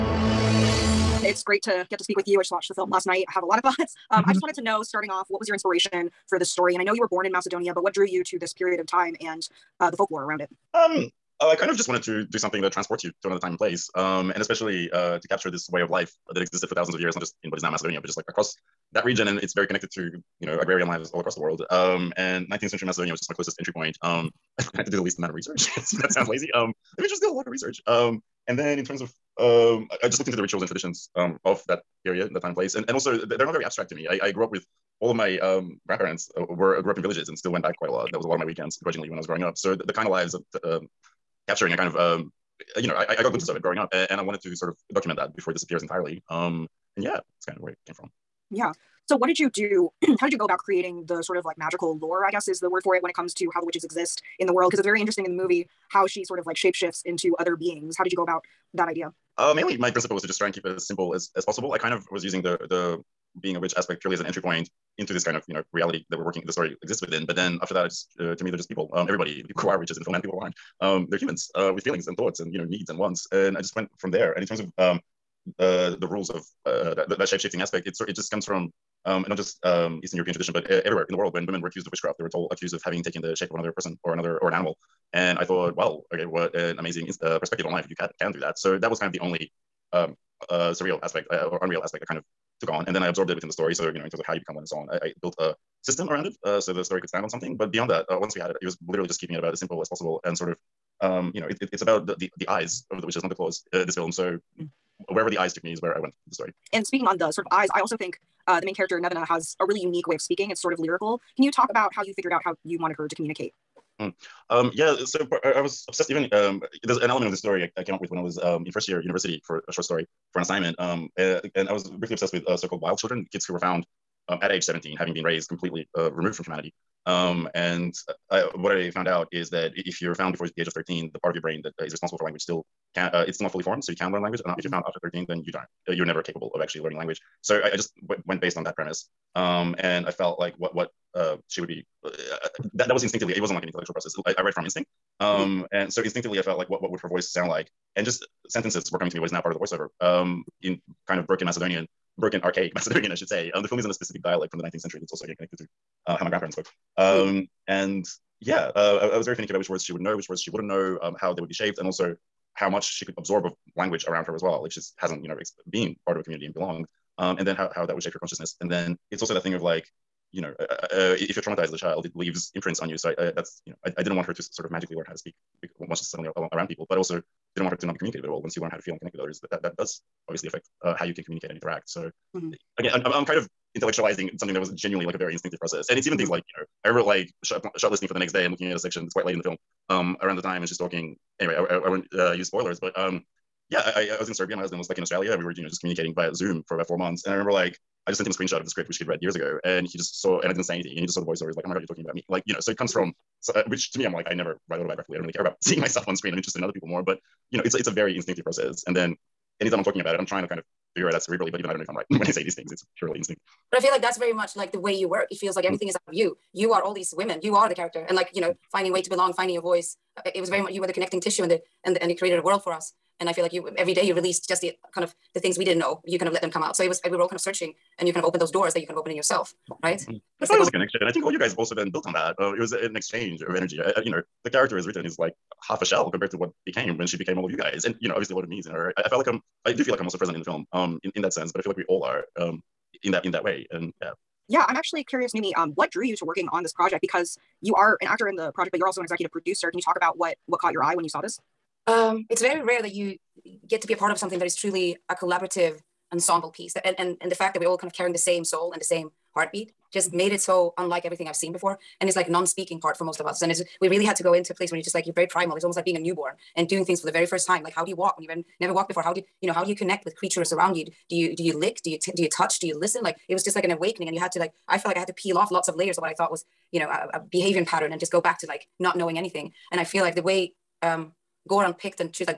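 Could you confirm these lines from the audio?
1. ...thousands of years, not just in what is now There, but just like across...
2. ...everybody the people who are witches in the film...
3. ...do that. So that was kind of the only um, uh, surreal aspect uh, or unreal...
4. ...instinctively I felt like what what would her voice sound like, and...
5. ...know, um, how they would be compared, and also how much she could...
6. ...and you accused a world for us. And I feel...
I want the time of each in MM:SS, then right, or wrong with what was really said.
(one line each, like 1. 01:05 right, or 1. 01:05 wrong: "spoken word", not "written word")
1. 00:16 wrong: "Macedonia", not "There"
2. 01:09 right
3. 01:28 right
4. 02:26 right
5. 02:40 wrong: "shaped", not "compared"
6. 03:42 wrong: "created", not "accused".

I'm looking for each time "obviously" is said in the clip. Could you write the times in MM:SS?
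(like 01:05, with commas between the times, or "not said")
03:00, 03:58.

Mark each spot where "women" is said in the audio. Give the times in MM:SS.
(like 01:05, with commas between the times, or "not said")
01:21, 03:37.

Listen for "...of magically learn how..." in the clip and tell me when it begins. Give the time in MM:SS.
02:54.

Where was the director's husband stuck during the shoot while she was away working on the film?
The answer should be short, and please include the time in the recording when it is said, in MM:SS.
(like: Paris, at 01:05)
Australia, at 03:15.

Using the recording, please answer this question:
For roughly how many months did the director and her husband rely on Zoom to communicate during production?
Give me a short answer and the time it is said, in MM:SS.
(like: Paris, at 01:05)
4, at 03:16.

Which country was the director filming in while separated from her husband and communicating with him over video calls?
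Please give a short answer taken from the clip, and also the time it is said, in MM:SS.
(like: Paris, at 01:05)
Serbia, at 03:14.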